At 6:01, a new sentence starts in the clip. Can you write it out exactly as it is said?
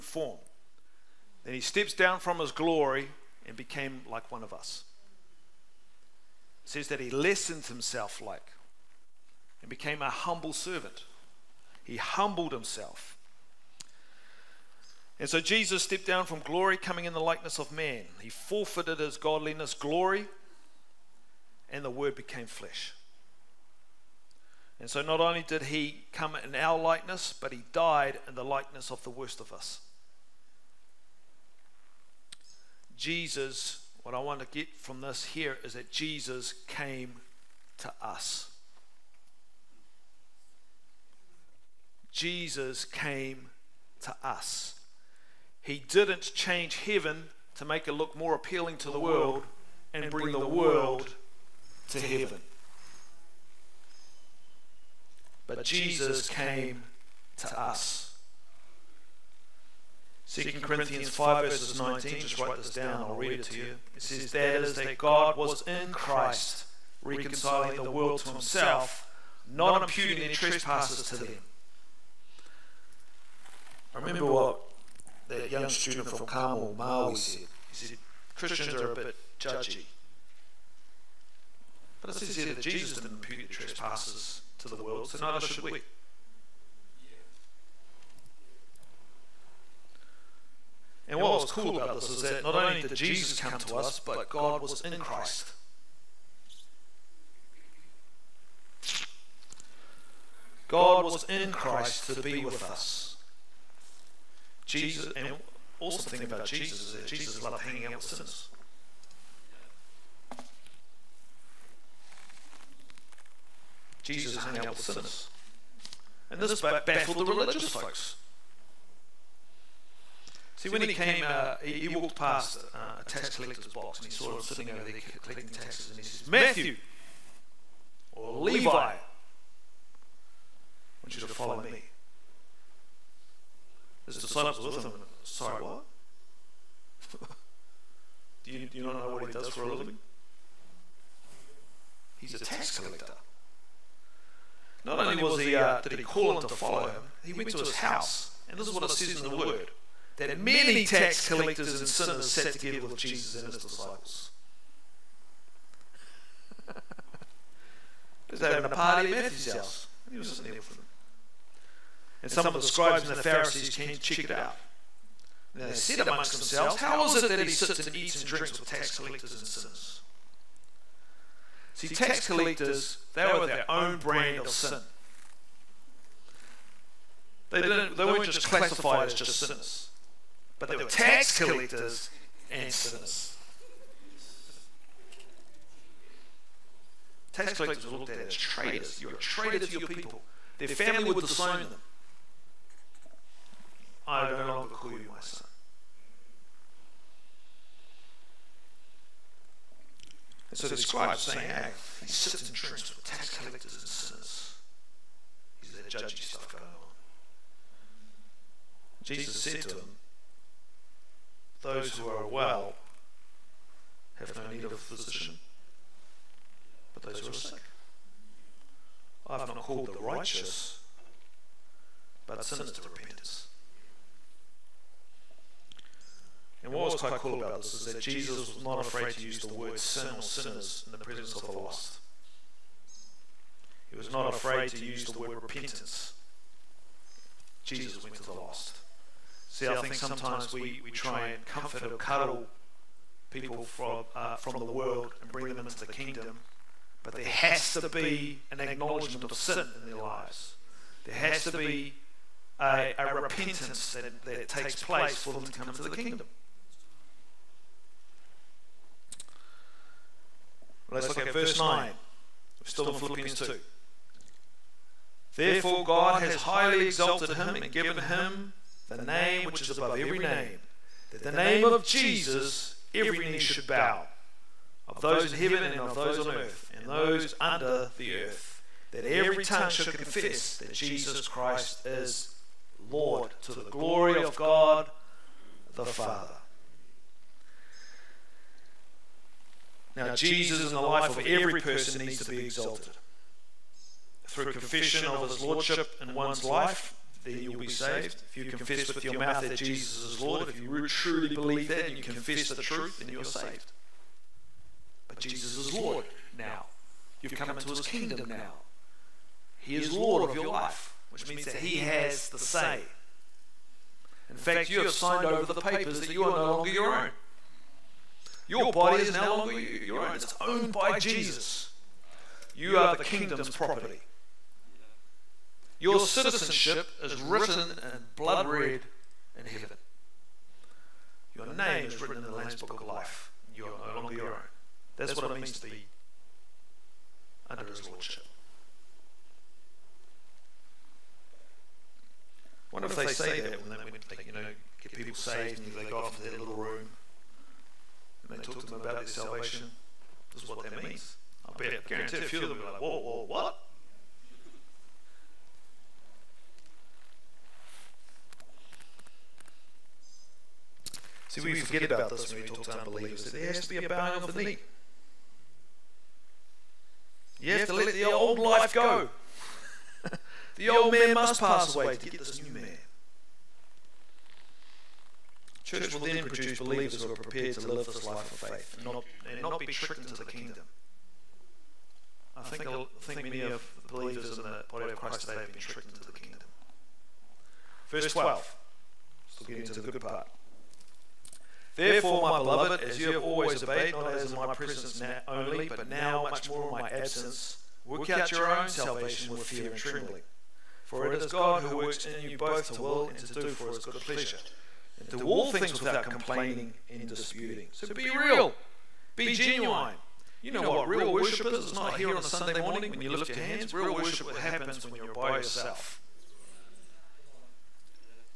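See, we forget about this when we talk to unbelievers, there has to be a bowing of the knee.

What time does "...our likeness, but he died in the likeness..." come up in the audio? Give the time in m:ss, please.
0:26.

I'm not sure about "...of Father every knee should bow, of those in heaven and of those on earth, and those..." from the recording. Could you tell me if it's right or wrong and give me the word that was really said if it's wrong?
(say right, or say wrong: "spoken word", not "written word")
wrong: "Jesus", not "Father".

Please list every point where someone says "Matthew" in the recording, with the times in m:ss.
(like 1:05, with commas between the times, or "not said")
2:06, 2:39.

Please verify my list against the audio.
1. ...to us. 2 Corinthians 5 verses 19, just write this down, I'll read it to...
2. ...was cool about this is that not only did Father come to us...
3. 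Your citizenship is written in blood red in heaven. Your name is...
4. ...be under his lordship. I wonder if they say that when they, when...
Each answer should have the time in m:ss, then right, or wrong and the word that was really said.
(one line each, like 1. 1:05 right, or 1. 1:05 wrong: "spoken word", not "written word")
1. 0:57 right
2. 1:31 wrong: "Jesus", not "Father"
3. 5:25 right
4. 5:35 right.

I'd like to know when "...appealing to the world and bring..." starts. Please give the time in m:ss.
0:48.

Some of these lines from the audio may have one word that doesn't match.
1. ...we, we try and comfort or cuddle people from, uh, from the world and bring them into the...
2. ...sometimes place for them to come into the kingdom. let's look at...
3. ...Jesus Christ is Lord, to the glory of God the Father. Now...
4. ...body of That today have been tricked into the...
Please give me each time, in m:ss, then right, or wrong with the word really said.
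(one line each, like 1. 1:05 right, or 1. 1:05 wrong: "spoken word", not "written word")
1. 4:00 right
2. 4:14 wrong: "takes", not "sometimes"
3. 4:40 right
4. 6:24 wrong: "Christ", not "That".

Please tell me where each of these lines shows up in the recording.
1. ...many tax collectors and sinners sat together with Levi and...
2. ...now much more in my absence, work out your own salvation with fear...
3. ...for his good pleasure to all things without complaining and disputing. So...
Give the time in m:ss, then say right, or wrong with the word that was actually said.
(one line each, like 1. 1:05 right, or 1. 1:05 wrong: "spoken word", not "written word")
1. 2:30 wrong: "Jesus", not "Levi"
2. 6:35 right
3. 6:43 right.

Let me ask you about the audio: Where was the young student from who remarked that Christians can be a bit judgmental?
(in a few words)
Carmel, Maui.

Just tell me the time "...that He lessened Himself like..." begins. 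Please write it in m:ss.
0:06.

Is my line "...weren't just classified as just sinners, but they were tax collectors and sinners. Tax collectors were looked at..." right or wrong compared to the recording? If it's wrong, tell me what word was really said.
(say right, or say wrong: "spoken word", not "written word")
right.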